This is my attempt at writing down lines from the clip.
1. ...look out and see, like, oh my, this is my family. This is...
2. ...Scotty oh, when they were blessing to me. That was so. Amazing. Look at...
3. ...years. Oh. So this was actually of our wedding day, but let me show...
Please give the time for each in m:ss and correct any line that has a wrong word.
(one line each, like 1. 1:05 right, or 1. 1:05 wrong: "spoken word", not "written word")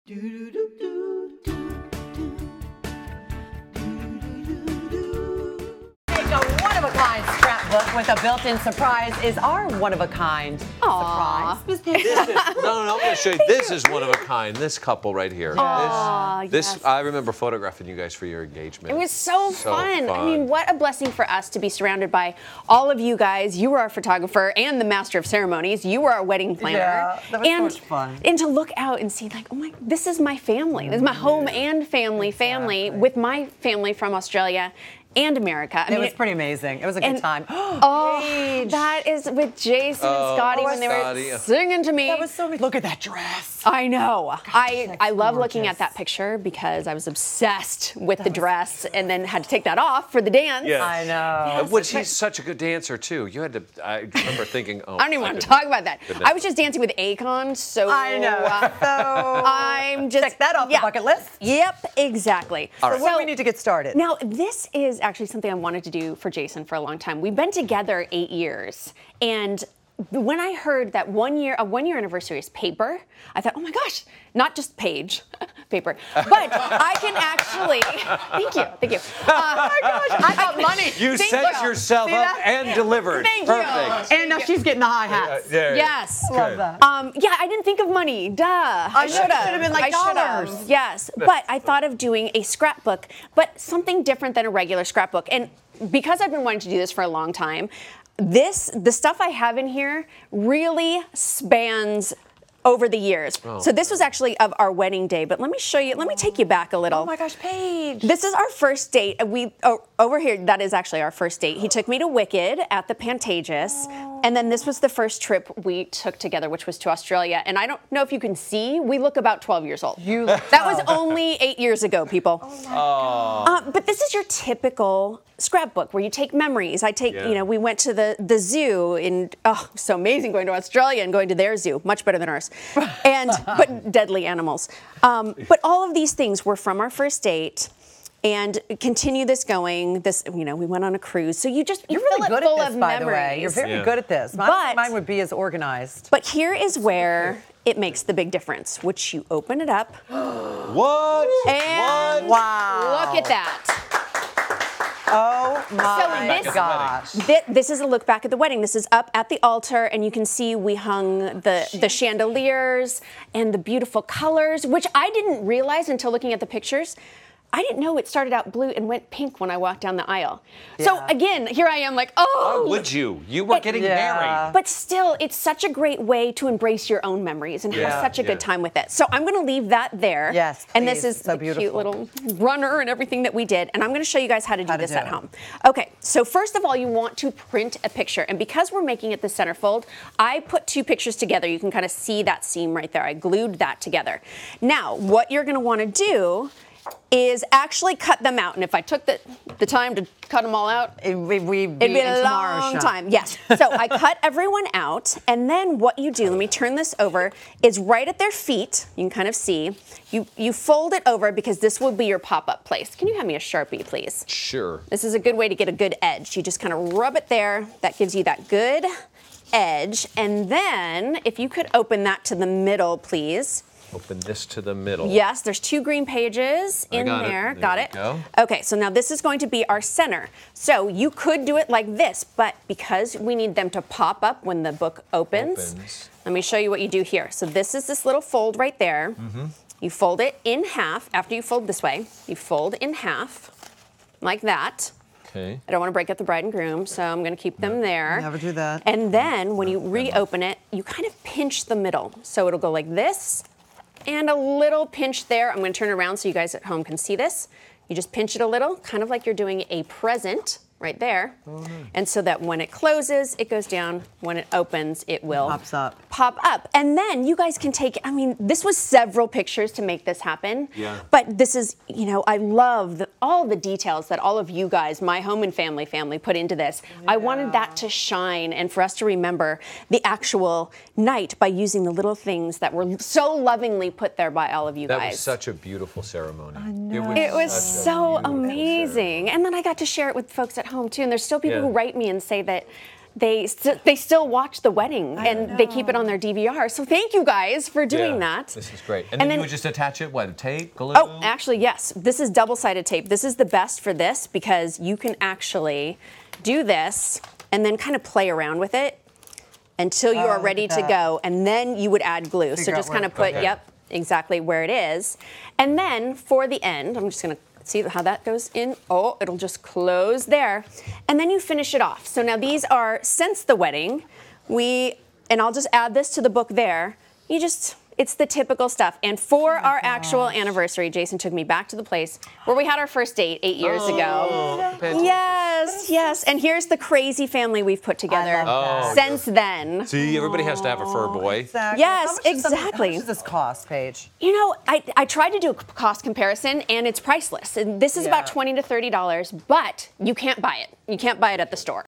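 1. 0:28 right
2. 0:40 wrong: "singing", not "blessing"
3. 1:42 right.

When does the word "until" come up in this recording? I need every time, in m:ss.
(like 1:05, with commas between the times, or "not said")
2:45, 5:09.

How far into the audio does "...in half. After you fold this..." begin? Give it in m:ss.
4:00.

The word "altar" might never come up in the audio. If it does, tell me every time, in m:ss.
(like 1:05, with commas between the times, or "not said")
2:39.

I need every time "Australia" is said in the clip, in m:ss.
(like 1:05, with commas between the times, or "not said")
0:34, 1:56, 2:10.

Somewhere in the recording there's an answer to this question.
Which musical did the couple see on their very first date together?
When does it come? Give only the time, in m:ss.
1:52.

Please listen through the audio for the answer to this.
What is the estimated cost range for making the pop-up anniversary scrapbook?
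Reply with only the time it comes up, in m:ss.
5:48.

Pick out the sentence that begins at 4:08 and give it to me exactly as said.
And then when you reopen it, you kind of pinch the middle.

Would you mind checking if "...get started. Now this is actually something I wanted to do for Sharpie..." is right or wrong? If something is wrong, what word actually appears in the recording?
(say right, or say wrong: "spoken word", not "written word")
wrong: "Jason", not "Sharpie".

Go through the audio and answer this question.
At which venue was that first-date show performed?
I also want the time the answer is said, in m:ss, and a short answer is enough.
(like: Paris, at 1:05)
the Pantages, at 1:52.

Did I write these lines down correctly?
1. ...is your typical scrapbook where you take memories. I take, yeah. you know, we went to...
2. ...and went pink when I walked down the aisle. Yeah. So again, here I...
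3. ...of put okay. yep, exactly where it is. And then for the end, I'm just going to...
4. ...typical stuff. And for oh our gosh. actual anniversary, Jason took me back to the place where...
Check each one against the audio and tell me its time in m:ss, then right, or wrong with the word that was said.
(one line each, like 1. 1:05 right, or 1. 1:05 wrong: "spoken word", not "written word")
1. 2:04 right
2. 2:48 right
3. 5:13 right
4. 5:28 right.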